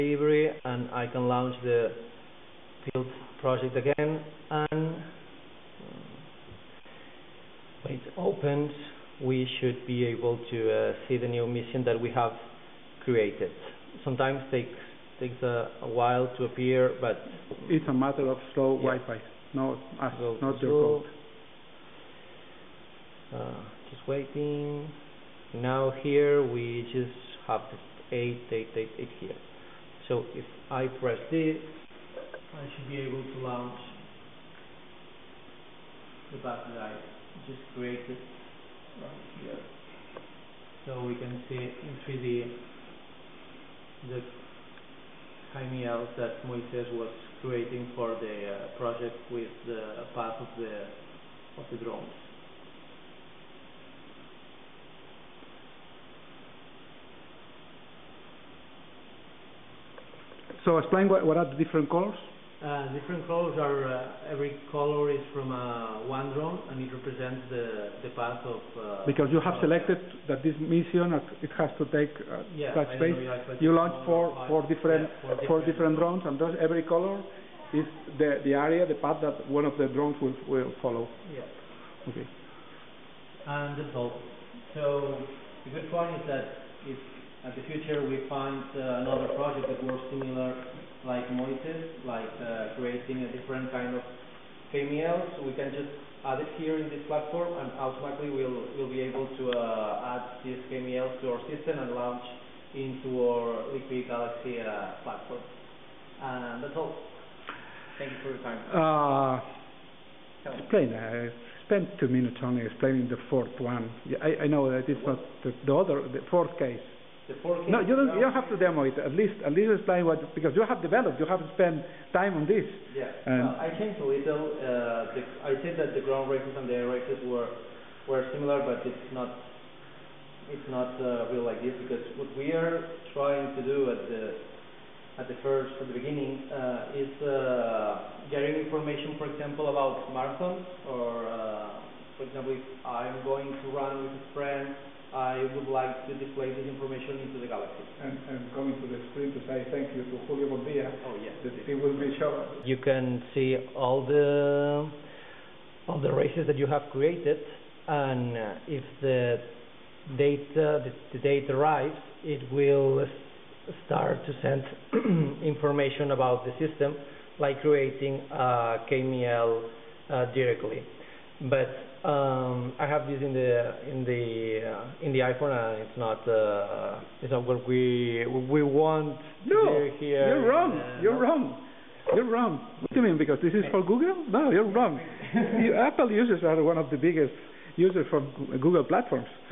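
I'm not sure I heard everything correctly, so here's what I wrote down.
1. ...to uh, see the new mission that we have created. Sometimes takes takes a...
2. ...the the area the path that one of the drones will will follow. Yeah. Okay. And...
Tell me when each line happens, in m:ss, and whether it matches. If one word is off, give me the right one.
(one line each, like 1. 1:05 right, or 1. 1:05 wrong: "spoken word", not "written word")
1. 0:10 right
2. 1:18 right.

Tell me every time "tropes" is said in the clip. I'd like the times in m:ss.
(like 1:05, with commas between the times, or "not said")
not said.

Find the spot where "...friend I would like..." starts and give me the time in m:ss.
2:24.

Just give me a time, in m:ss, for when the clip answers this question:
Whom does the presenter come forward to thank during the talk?
2:30.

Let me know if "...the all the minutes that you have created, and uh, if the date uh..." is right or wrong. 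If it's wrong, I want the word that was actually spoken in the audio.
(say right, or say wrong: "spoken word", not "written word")
wrong: "races", not "minutes".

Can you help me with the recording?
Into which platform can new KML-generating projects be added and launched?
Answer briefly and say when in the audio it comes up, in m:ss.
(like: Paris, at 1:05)
Liquid Galaxy, at 1:43.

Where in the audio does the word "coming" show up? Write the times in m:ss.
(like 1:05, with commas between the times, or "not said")
2:28.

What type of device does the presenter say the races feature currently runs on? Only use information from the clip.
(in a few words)
iPhone.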